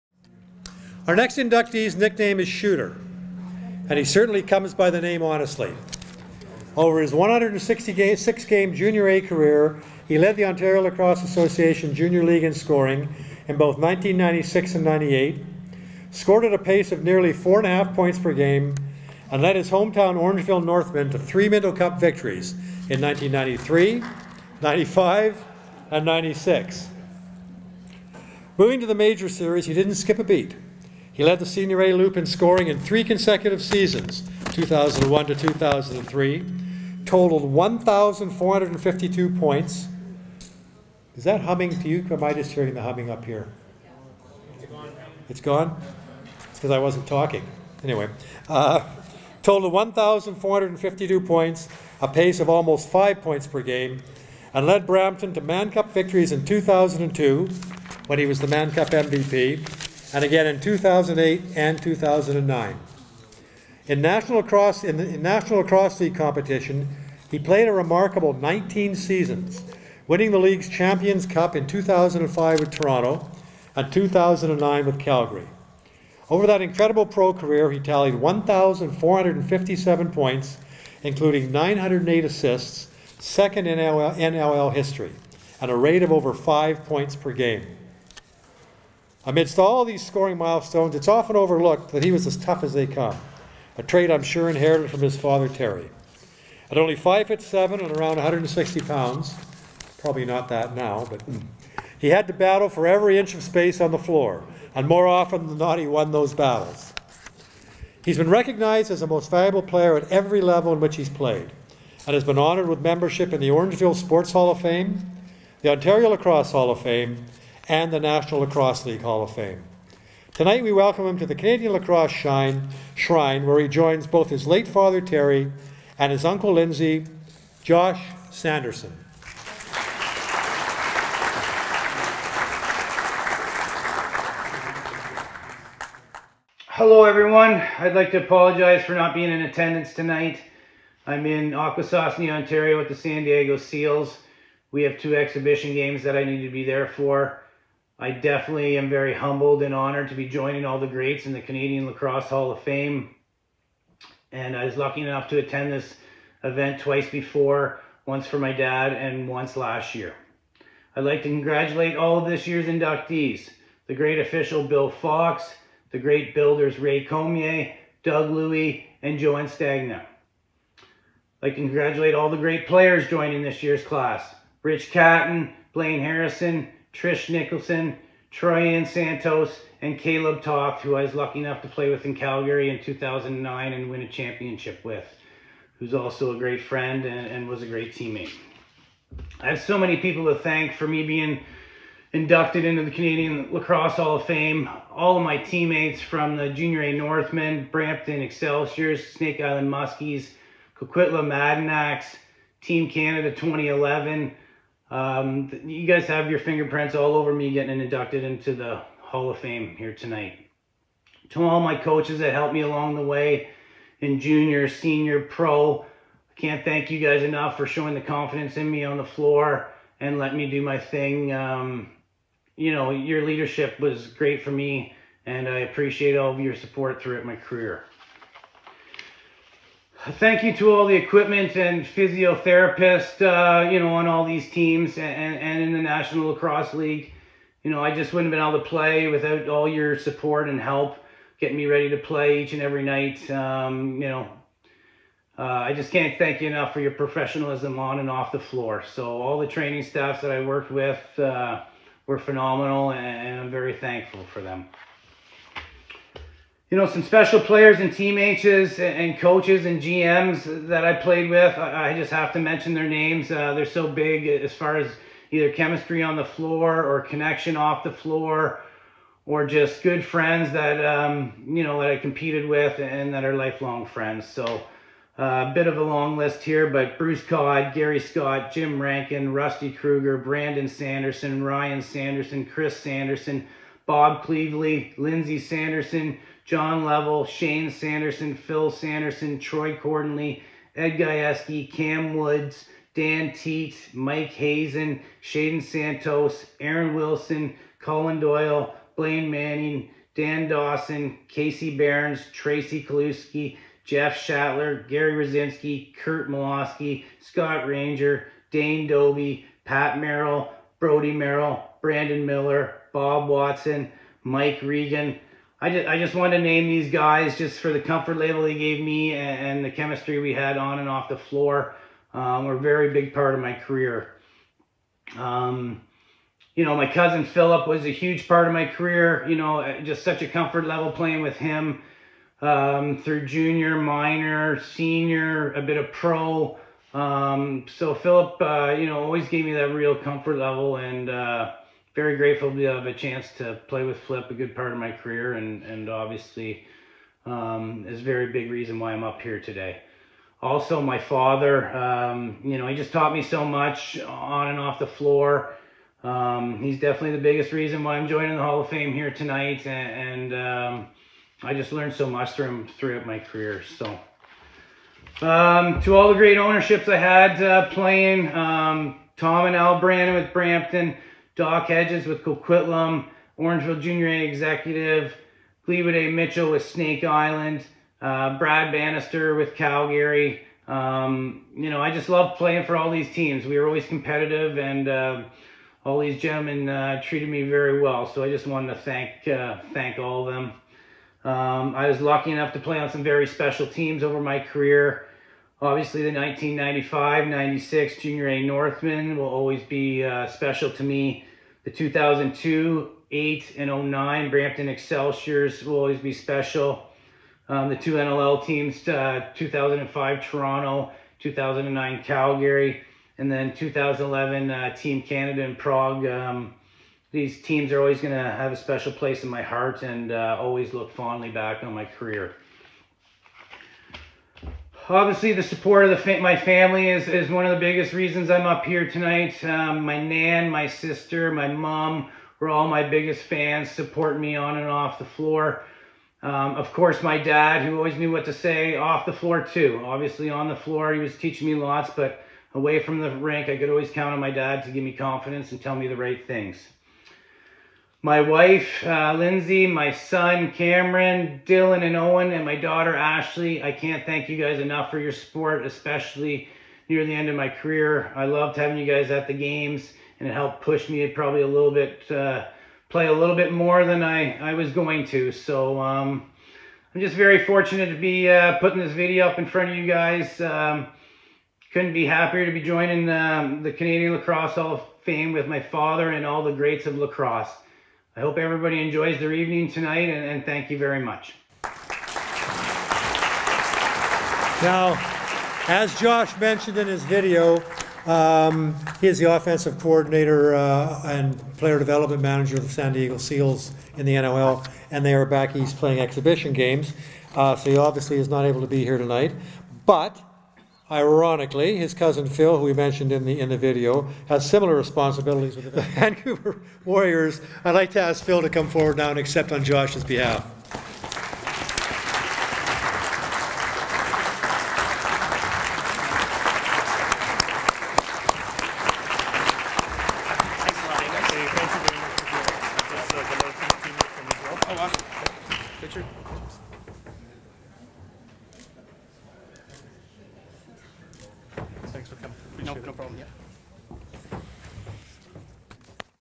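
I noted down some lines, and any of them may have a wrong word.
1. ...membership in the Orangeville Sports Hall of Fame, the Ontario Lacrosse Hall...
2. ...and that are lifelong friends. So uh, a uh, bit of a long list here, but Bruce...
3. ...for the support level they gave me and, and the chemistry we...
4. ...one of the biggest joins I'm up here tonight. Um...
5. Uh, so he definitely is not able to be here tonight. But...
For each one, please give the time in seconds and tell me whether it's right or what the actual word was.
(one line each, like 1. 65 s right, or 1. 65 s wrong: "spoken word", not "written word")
1. 112 s right
2. 272 s right
3. 317 s wrong: "comfort", not "support"
4. 427 s wrong: "reasons", not "joins"
5. 497 s wrong: "obviously", not "definitely".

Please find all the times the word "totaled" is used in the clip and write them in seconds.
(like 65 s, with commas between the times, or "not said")
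37 s, 49 s.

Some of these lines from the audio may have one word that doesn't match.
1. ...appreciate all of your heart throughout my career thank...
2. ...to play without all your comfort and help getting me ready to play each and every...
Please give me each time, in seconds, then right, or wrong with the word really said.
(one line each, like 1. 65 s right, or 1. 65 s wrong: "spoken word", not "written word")
1. 225 s wrong: "support", not "heart"
2. 238 s wrong: "support", not "comfort".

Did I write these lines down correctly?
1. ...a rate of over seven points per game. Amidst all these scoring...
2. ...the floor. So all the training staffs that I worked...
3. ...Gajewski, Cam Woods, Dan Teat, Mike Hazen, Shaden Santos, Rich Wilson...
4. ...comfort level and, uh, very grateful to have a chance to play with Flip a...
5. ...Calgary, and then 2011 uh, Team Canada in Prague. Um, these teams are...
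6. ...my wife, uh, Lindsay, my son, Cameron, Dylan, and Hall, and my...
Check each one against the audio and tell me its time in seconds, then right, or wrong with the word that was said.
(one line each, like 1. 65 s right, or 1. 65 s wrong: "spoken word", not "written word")
1. 85 s wrong: "five", not "seven"
2. 248 s right
3. 290 s wrong: "Aaron", not "Rich"
4. 339 s right
5. 412 s right
6. 448 s wrong: "Owen", not "Hall".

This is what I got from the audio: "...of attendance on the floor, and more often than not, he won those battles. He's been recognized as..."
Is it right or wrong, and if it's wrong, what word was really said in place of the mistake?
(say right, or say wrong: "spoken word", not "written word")
wrong: "space", not "attendance".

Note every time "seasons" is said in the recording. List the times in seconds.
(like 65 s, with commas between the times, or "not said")
33 s, 68 s.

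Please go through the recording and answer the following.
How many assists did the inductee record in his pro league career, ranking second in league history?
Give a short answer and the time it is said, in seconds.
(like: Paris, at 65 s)
908, at 81 s.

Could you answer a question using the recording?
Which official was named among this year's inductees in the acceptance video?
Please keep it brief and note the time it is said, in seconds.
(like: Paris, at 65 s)
Bill Fox, at 164 s.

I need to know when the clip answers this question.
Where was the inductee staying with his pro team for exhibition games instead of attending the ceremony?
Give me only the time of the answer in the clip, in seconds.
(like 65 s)
141 s.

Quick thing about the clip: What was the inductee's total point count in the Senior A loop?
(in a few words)
1,452.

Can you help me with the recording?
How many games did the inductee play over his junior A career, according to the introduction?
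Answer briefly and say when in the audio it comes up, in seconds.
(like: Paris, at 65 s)
166, at 7 s.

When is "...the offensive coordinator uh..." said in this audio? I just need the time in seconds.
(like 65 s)
489 s.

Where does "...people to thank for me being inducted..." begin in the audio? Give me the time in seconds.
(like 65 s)
189 s.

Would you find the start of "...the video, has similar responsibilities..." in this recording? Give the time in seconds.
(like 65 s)
503 s.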